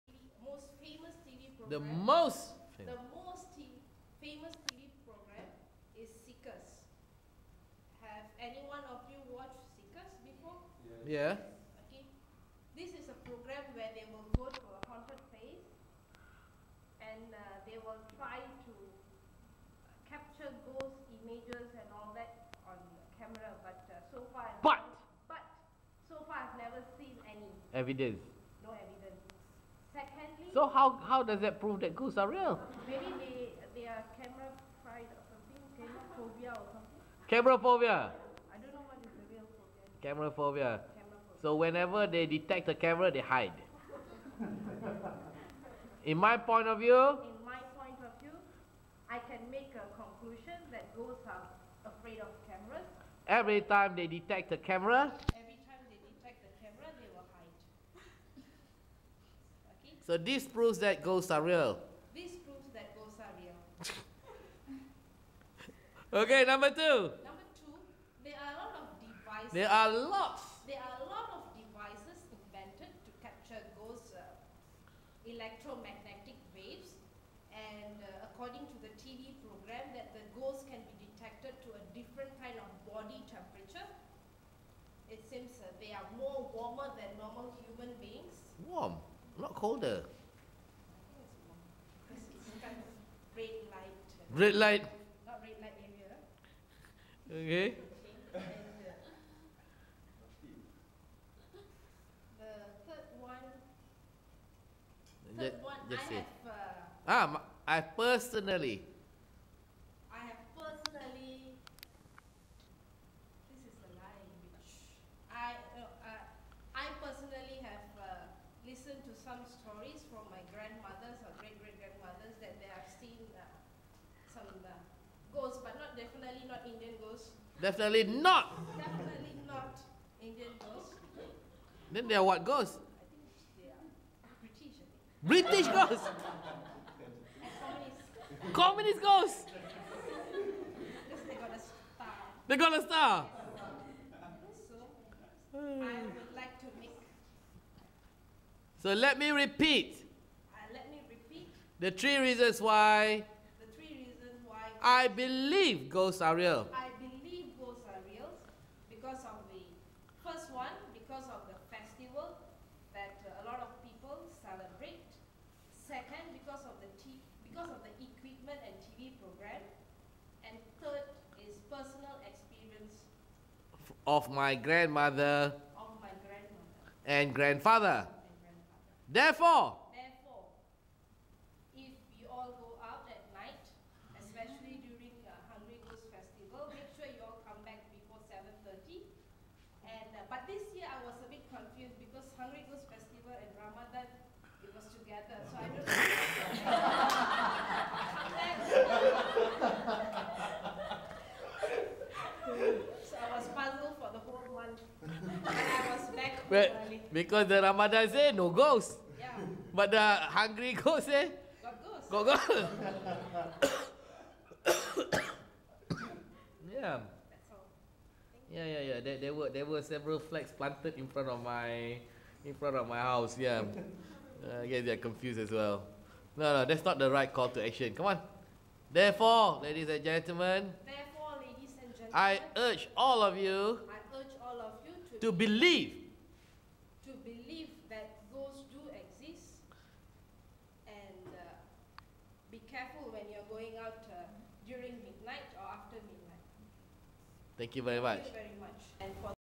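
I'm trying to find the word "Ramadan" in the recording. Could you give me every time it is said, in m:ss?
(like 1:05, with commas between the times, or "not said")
3:13, 3:27.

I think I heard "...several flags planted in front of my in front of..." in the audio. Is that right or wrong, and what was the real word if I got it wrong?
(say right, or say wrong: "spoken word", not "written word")
right.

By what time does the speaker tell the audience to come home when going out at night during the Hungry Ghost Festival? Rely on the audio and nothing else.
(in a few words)
7:30.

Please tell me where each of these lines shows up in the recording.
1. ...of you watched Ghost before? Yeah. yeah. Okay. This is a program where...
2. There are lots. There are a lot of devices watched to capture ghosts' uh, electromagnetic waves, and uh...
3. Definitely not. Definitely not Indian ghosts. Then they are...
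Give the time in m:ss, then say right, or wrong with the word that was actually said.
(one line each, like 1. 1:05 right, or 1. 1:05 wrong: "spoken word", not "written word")
1. 0:08 wrong: "Seekers", not "Ghost"
2. 1:09 wrong: "invented", not "watched"
3. 2:07 right.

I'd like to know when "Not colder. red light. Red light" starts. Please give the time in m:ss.
1:29.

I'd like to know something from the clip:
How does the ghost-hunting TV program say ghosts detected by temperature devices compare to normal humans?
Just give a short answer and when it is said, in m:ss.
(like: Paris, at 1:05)
Warmer, at 1:26.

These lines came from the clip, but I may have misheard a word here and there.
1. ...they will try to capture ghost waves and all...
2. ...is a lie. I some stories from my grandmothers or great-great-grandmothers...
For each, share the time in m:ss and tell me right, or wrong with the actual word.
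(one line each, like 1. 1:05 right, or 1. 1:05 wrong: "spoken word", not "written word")
1. 0:17 wrong: "images", not "waves"
2. 1:53 right.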